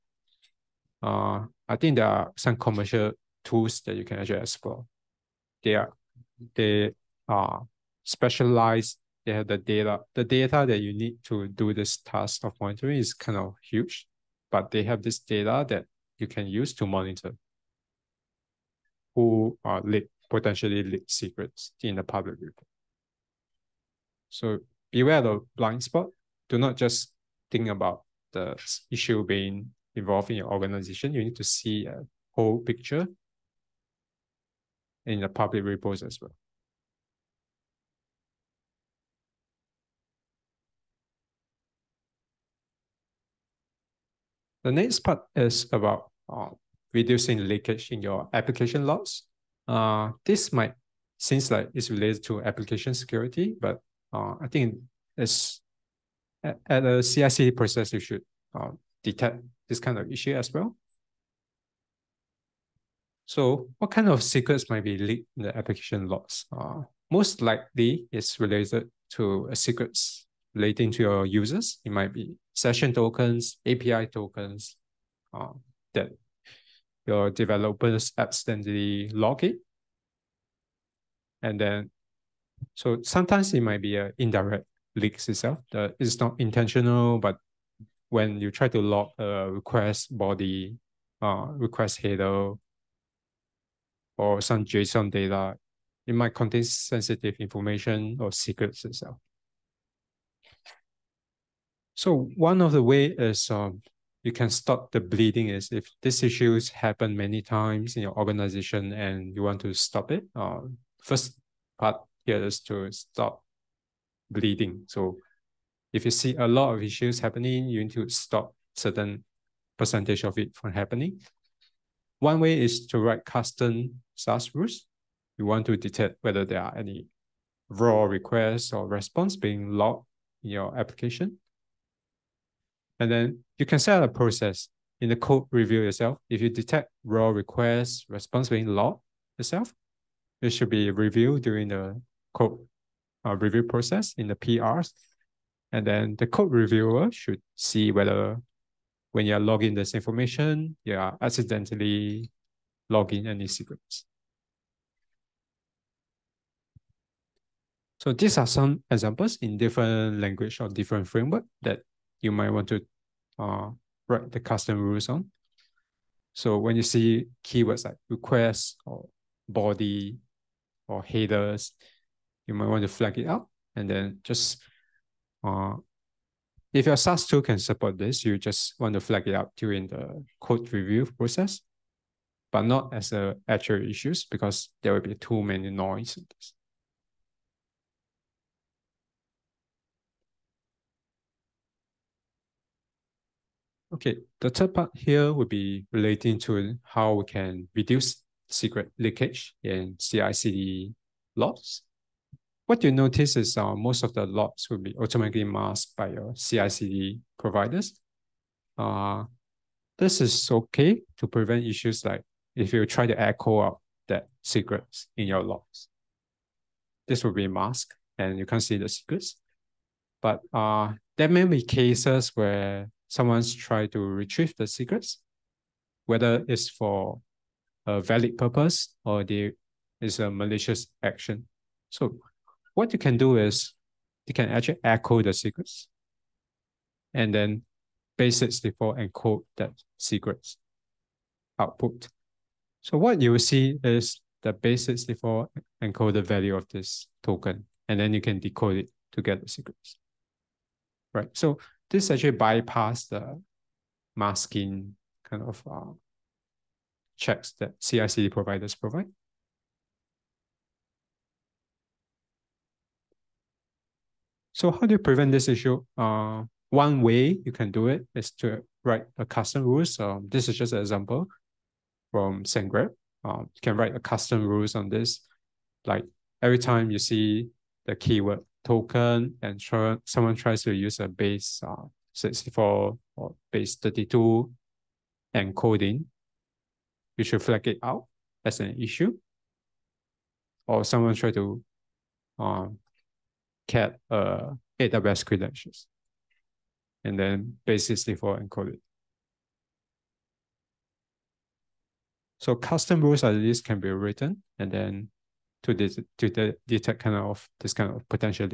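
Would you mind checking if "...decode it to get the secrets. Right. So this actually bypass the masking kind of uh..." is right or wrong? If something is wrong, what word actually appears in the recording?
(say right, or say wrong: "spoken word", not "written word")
right.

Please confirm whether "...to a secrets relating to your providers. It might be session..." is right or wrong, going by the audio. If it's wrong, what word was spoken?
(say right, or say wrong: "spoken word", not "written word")
wrong: "users", not "providers".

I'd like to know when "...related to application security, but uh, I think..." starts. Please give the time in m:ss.
0:51.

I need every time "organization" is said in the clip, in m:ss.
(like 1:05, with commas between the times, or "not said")
0:30, 1:48.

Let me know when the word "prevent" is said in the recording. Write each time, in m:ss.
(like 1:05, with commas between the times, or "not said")
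3:31, 4:24.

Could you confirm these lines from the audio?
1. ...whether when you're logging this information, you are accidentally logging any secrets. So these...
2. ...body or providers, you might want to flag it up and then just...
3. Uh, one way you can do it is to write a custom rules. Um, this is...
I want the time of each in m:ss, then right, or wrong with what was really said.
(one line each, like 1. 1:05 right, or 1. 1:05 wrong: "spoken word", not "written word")
1. 2:27 right
2. 2:49 wrong: "headers", not "providers"
3. 4:25 right.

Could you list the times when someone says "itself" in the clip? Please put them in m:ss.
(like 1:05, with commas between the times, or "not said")
1:25, 1:38, 2:19.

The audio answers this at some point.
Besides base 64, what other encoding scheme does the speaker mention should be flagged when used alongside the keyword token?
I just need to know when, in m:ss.
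4:43.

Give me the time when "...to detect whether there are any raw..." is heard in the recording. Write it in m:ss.
2:05.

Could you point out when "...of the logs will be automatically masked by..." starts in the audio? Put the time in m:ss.
3:24.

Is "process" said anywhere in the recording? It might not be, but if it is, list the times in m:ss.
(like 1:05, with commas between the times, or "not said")
0:57, 2:14, 2:23, 3:01.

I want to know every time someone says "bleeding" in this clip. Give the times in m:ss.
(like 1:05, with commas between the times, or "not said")
1:45, 1:54.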